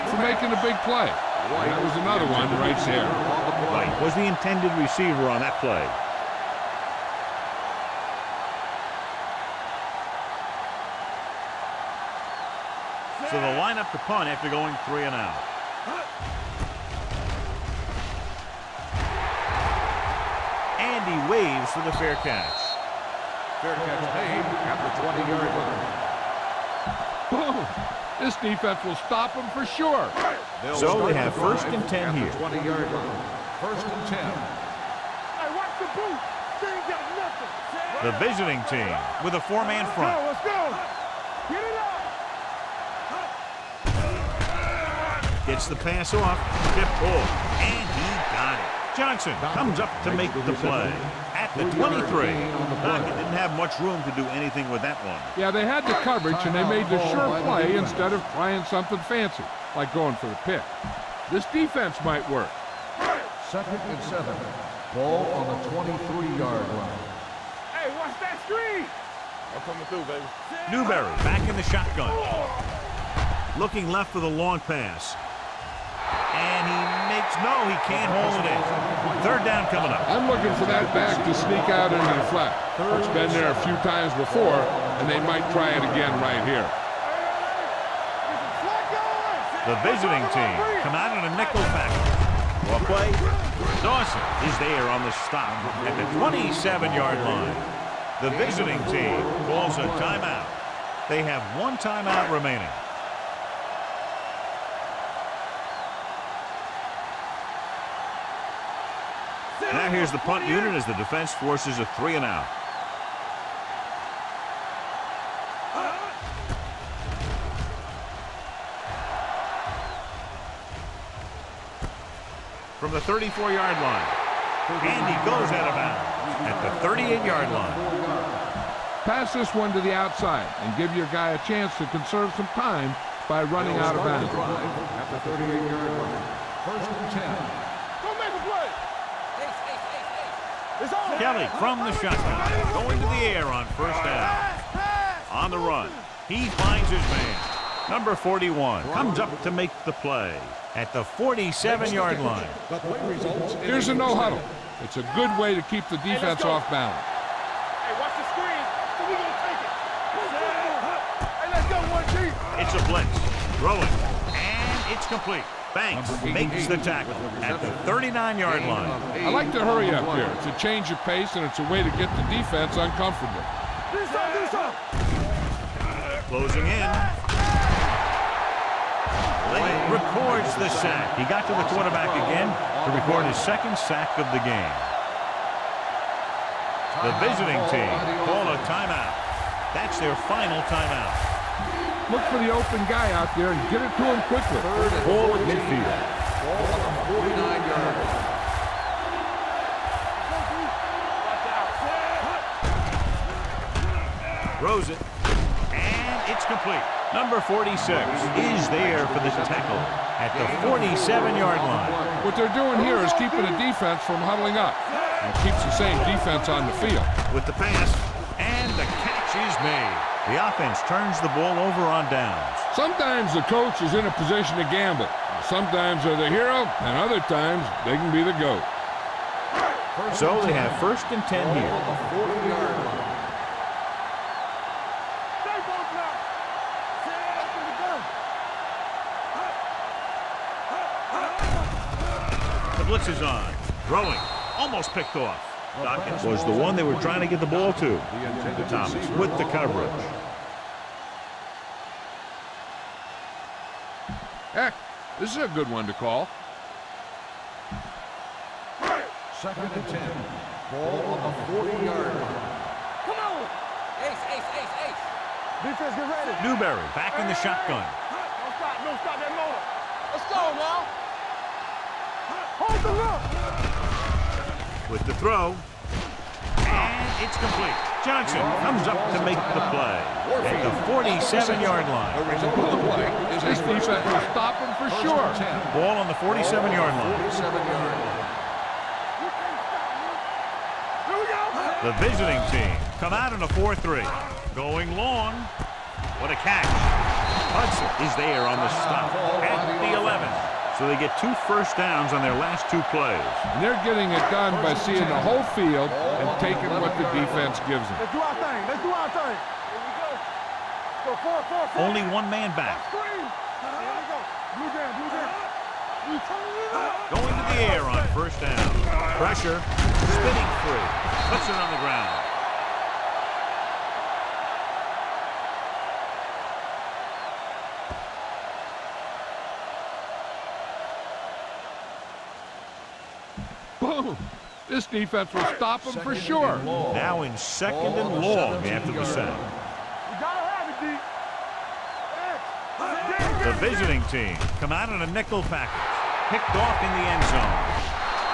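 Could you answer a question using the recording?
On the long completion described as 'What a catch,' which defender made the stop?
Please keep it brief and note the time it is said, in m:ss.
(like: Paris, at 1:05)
Hudson, at 4:57.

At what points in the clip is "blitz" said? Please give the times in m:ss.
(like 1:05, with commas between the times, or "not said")
2:42, 4:02.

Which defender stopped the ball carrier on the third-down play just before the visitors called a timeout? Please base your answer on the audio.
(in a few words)
Dawson.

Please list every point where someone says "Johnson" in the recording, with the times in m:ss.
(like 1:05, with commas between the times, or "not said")
0:48, 4:38.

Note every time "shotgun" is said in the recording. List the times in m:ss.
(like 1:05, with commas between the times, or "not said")
1:11, 2:22, 4:27.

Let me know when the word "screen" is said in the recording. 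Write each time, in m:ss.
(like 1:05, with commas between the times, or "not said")
1:08, 2:38.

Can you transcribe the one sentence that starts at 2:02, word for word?
From the 34-yard line, Andy goes out of bounds at the 38-yard line.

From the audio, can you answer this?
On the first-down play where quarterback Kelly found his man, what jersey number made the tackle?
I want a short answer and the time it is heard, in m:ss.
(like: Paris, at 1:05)
41, at 2:27.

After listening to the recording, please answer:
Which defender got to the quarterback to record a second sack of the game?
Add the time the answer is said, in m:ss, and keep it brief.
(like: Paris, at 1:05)
Lane, at 2:59.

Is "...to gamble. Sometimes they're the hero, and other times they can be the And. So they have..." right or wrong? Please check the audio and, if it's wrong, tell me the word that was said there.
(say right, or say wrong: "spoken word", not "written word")
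wrong: "GOAT", not "And".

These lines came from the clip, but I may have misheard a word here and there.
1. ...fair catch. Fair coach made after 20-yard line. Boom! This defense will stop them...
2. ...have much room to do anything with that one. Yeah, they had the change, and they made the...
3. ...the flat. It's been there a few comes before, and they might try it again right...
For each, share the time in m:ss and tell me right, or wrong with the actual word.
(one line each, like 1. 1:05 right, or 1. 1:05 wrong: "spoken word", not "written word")
1. 0:21 wrong: "catch", not "coach"
2. 0:53 wrong: "coverage", not "change"
3. 1:22 wrong: "times", not "comes".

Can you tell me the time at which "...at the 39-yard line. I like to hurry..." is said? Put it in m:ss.
2:47.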